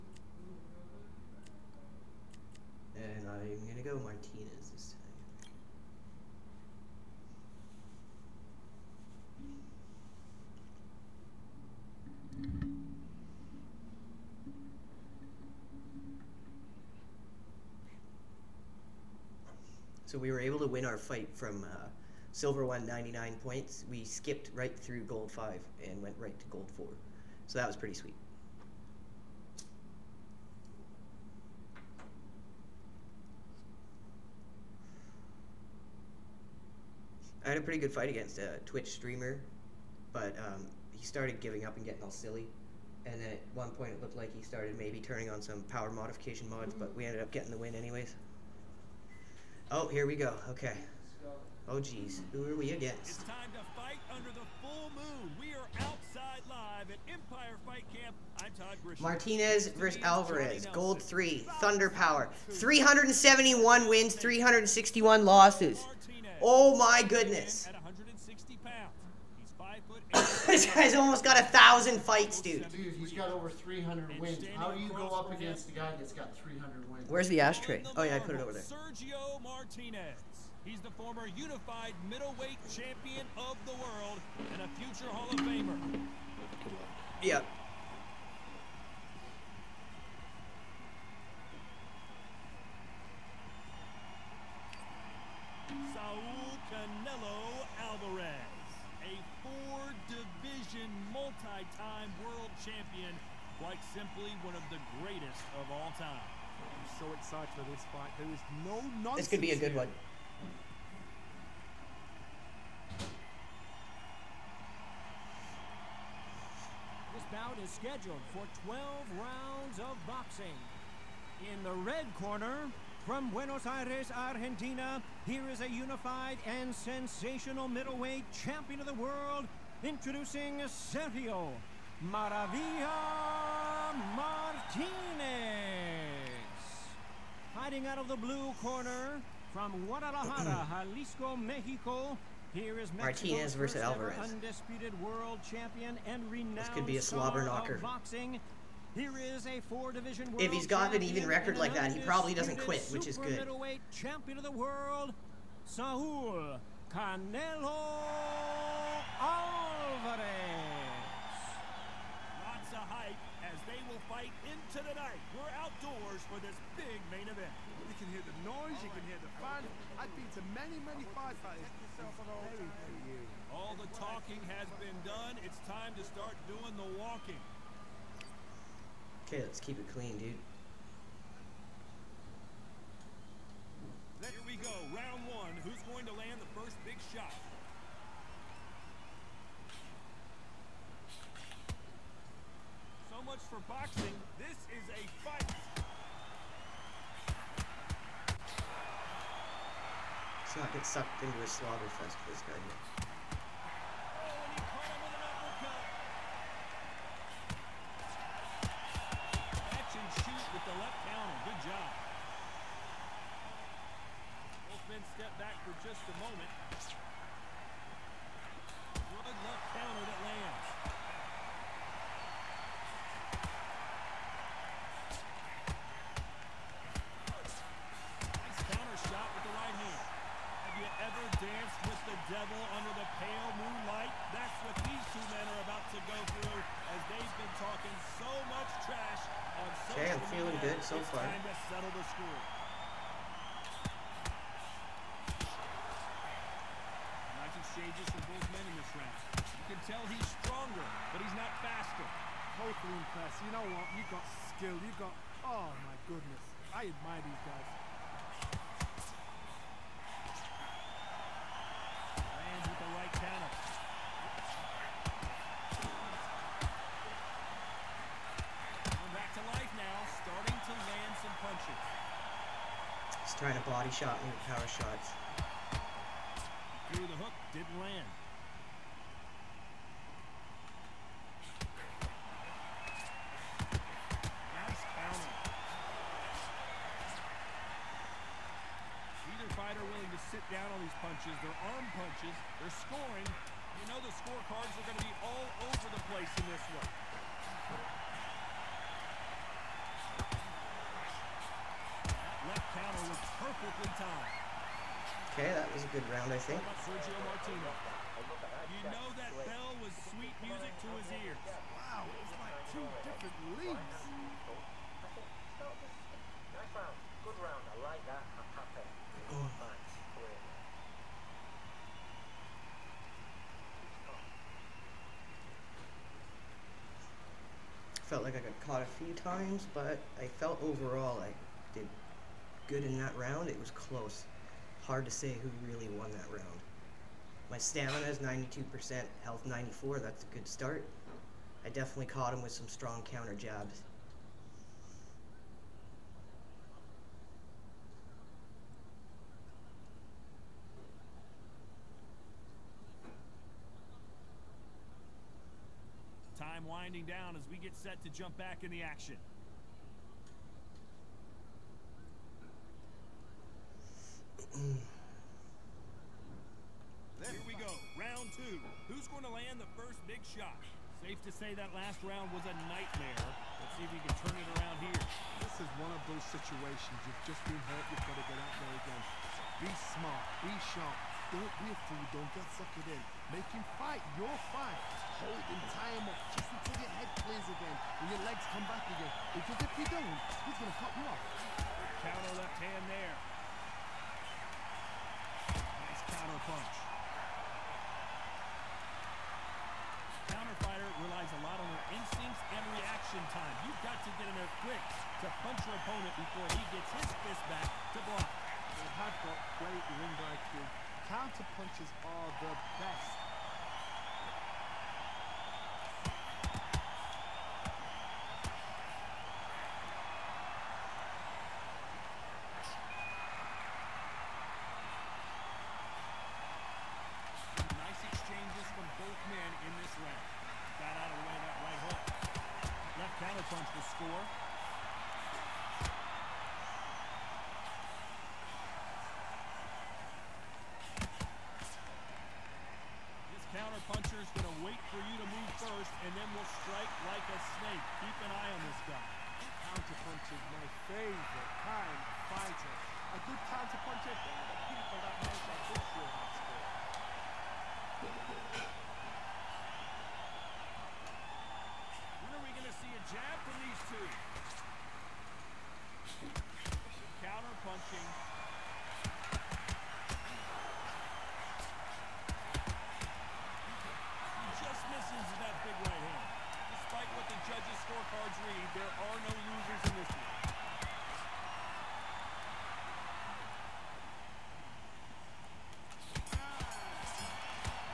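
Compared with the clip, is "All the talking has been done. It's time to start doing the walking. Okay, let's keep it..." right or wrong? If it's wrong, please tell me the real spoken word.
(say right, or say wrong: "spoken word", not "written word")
right.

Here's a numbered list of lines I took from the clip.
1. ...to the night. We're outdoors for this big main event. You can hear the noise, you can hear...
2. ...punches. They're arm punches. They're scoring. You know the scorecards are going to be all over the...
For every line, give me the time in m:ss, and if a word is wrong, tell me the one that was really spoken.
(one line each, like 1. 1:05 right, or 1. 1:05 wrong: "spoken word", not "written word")
1. 2:44 right
2. 4:50 right.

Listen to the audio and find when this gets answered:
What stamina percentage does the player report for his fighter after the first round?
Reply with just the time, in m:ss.
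5:38.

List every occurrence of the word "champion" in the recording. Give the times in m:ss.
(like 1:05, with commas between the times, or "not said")
1:22, 1:42, 2:08, 2:25, 2:33.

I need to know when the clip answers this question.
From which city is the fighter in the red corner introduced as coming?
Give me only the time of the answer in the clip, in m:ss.
2:03.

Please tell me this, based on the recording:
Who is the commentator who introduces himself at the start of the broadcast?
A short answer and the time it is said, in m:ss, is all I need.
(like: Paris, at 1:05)
Todd Grisham, at 0:58.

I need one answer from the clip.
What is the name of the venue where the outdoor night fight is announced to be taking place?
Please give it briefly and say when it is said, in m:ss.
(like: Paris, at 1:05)
Empire Fight Camp, at 0:57.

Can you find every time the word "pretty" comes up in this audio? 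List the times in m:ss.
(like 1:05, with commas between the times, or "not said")
0:27, 0:37.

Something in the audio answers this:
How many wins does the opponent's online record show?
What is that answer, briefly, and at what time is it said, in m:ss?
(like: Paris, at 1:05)
371, at 1:02.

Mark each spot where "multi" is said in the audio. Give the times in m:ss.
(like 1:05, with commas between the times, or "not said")
1:41.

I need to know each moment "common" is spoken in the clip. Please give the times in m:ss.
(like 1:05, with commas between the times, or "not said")
not said.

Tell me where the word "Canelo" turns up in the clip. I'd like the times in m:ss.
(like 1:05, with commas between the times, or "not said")
1:36, 2:36.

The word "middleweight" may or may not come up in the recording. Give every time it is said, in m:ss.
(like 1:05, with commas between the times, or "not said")
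1:22, 2:07.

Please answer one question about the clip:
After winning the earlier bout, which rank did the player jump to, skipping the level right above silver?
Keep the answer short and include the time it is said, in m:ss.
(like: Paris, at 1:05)
Gold 4, at 0:26.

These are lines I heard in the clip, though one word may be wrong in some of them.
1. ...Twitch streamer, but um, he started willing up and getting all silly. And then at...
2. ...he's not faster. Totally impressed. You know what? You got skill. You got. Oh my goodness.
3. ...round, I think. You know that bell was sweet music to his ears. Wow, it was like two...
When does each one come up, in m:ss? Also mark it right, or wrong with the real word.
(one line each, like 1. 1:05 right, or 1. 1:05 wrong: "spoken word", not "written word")
1. 0:38 wrong: "giving", not "willing"
2. 4:11 right
3. 5:06 right.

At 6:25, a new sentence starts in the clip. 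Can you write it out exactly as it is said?
Hold him, tie him up just until your head clears again and your legs come back again.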